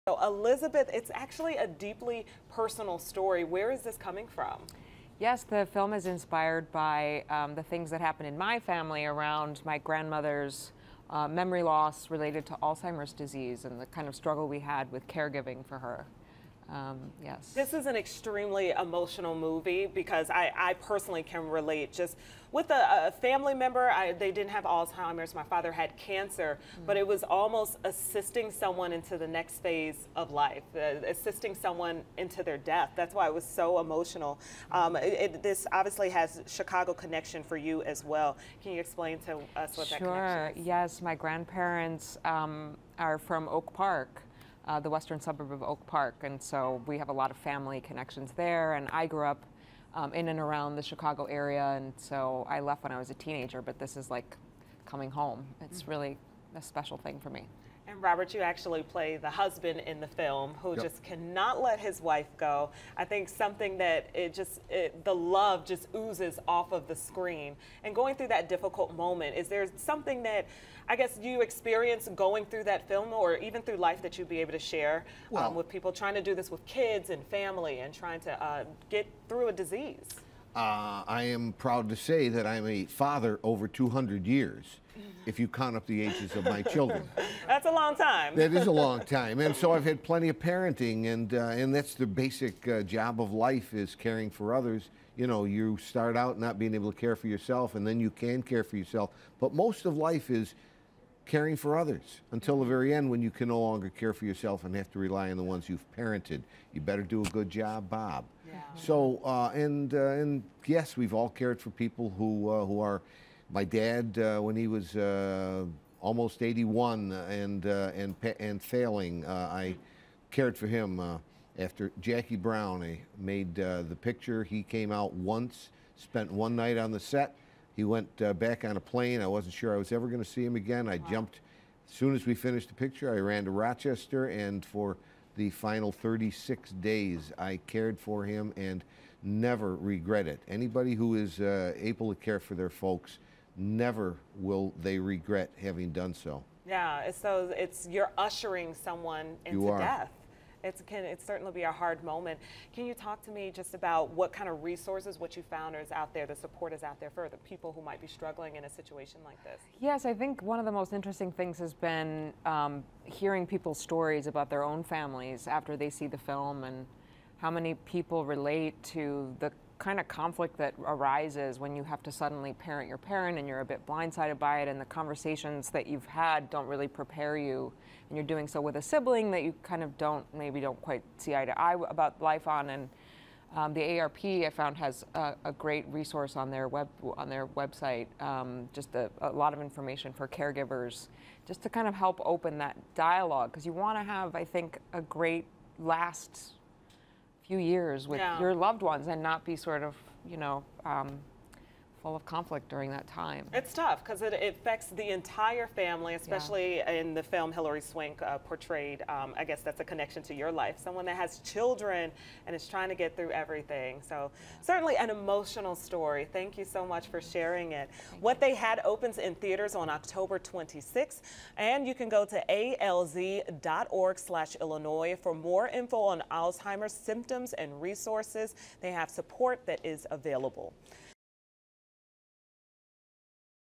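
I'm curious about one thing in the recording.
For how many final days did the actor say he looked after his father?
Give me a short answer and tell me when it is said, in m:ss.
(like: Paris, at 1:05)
36, at 2:15.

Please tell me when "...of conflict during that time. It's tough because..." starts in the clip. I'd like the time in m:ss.
3:22.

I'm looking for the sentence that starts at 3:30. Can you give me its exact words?
Someone that has children and is trying to get through everything.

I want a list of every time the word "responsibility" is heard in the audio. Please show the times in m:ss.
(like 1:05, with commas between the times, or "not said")
not said.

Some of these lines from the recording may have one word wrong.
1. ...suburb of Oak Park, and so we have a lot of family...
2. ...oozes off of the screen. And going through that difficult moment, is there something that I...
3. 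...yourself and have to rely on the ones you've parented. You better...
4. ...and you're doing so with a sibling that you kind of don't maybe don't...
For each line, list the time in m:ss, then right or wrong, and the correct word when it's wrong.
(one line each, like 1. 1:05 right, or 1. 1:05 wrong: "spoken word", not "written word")
1. 0:45 right
2. 1:05 right
3. 1:44 right
4. 2:58 right.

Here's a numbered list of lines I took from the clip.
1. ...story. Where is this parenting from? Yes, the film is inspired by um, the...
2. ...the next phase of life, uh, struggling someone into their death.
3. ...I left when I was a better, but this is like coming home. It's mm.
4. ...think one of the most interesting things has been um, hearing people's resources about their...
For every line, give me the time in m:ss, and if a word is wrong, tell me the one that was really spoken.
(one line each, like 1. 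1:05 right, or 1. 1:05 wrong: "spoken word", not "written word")
1. 0:02 wrong: "coming", not "parenting"
2. 0:29 wrong: "assisting", not "struggling"
3. 0:52 wrong: "teenager", not "better"
4. 2:40 wrong: "stories", not "resources".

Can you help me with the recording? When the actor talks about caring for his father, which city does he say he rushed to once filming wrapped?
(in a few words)
Rochester.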